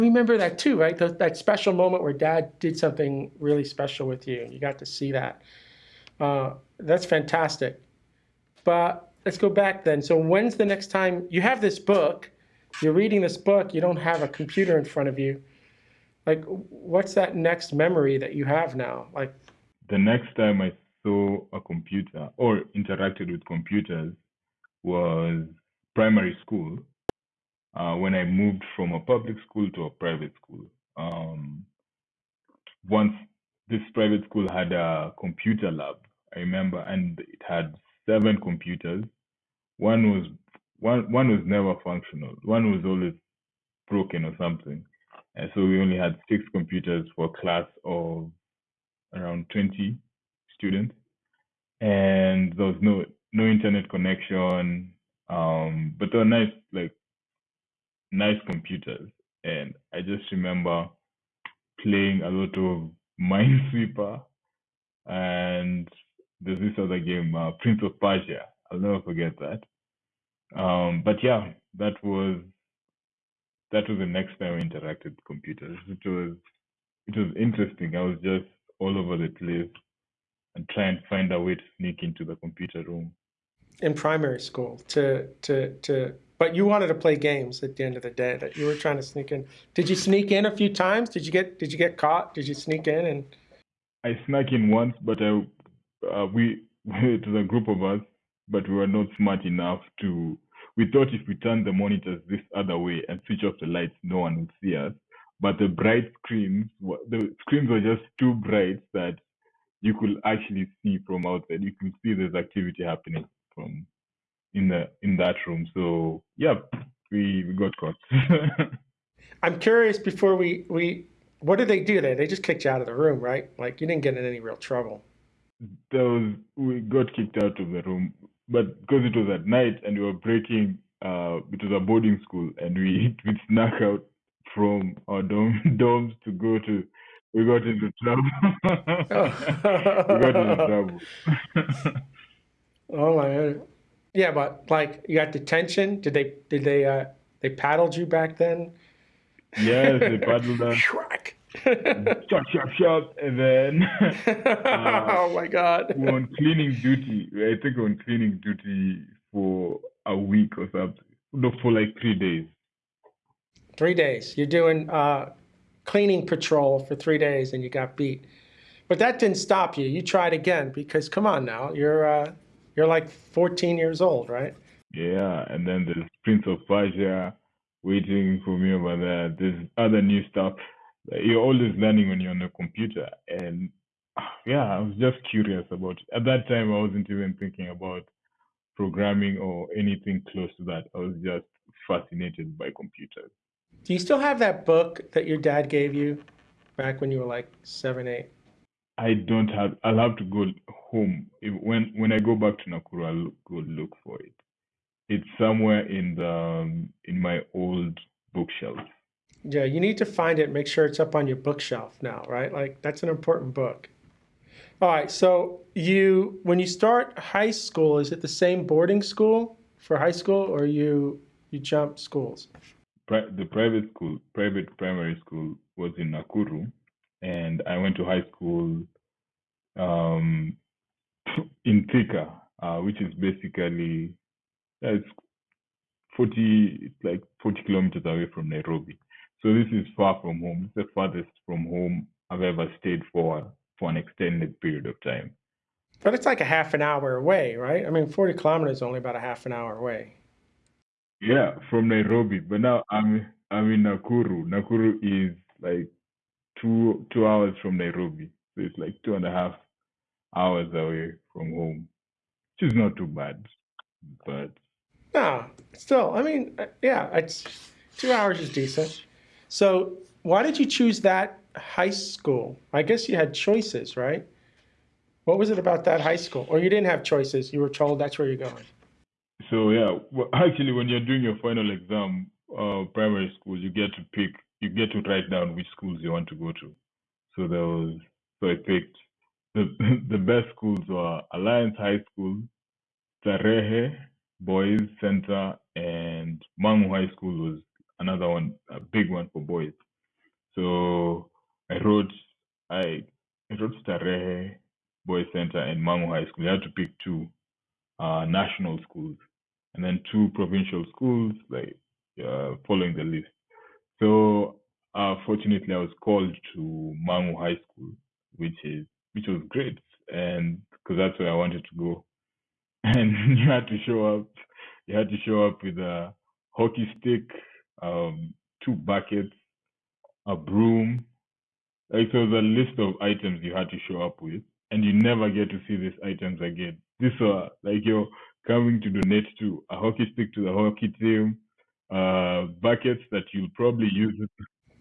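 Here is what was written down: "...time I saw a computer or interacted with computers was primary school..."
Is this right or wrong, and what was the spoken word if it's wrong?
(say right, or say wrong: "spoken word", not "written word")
right.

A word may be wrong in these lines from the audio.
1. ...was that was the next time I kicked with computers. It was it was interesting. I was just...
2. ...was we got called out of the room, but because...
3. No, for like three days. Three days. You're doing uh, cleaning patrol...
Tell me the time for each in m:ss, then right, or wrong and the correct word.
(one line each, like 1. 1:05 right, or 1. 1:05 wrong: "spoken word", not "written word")
1. 1:12 wrong: "interacted", not "kicked"
2. 2:06 wrong: "kicked", not "called"
3. 2:41 right.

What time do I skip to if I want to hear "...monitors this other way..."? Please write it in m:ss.
1:41.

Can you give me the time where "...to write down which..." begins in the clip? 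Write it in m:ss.
4:44.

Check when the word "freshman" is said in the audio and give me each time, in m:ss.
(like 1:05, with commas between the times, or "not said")
not said.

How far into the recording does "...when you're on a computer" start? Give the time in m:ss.
3:02.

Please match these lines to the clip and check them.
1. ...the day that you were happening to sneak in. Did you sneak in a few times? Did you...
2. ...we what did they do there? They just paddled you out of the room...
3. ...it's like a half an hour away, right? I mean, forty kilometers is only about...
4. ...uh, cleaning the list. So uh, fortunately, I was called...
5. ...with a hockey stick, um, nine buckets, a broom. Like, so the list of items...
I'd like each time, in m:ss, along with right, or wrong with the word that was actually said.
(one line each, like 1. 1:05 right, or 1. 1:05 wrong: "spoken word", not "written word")
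1. 1:28 wrong: "trying", not "happening"
2. 2:00 wrong: "kicked", not "paddled"
3. 4:06 right
4. 5:12 wrong: "following", not "cleaning"
5. 5:25 wrong: "two", not "nine".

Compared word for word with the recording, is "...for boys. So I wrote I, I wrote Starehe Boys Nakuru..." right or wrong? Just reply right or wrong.
wrong.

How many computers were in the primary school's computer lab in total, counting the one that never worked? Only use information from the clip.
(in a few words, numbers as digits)
7.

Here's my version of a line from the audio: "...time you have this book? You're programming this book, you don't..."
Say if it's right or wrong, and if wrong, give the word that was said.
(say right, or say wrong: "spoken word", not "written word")
wrong: "reading", not "programming".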